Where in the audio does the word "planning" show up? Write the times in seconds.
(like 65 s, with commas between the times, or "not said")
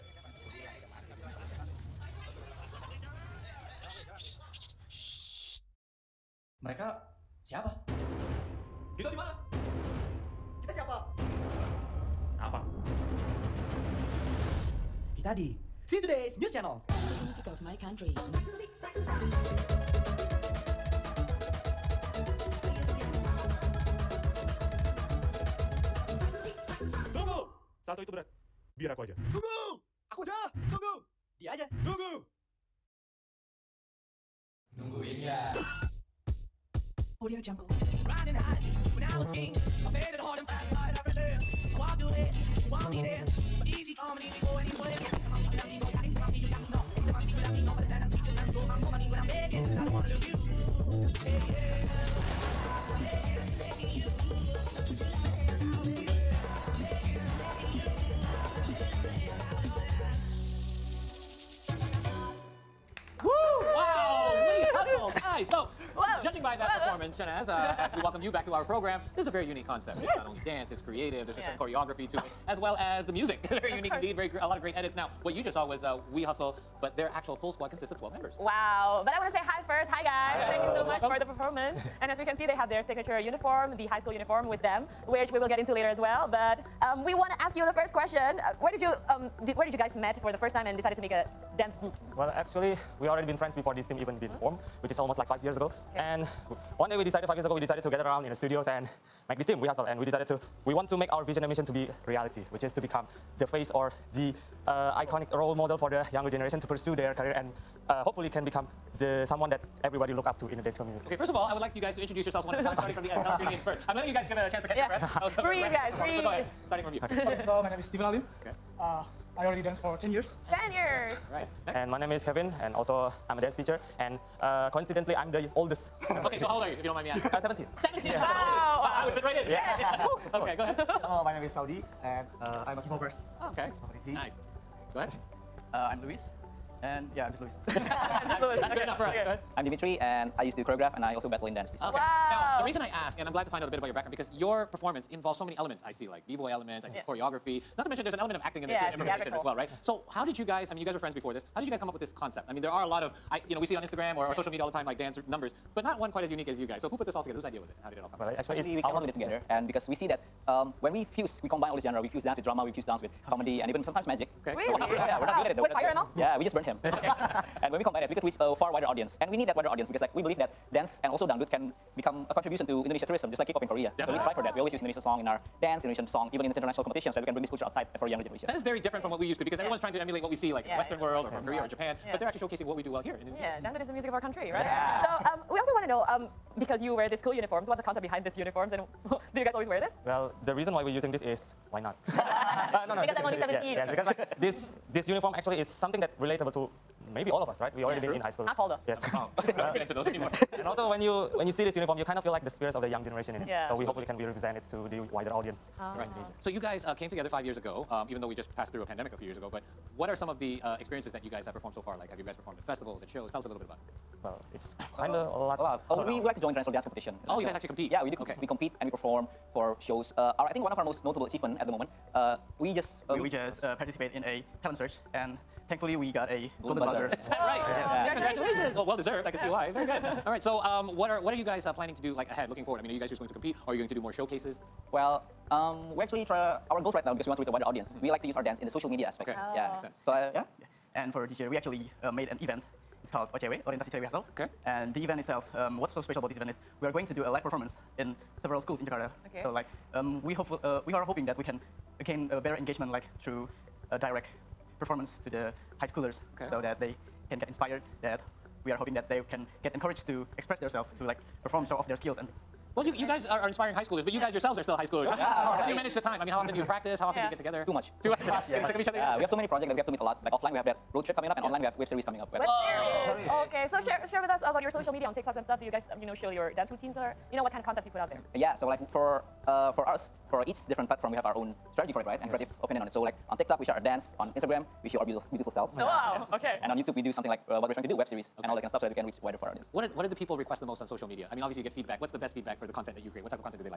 231 s.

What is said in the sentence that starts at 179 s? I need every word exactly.
everyone's trying to emulate what we see like in yeah, the Western world or from Korea or Japan, yeah.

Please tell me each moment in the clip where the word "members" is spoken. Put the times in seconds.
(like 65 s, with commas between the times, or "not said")
78 s.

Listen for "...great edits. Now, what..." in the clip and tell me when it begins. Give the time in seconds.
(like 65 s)
74 s.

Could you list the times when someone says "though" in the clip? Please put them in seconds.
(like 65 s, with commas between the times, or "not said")
165 s, 198 s, 208 s.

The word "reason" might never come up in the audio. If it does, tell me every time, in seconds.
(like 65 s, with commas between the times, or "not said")
142 s, 190 s.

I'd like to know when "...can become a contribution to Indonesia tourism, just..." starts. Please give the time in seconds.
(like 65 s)
171 s.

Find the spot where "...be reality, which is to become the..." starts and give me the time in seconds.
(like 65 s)
101 s.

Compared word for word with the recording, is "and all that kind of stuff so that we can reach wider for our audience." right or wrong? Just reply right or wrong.
right.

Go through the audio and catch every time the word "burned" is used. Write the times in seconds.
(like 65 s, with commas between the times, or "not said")
166 s.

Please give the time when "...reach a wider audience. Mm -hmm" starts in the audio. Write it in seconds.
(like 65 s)
237 s.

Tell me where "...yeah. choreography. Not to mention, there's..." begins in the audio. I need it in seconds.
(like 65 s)
146 s.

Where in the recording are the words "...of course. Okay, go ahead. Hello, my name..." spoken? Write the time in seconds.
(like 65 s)
130 s.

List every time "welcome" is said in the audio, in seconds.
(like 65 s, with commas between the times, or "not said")
68 s, 81 s.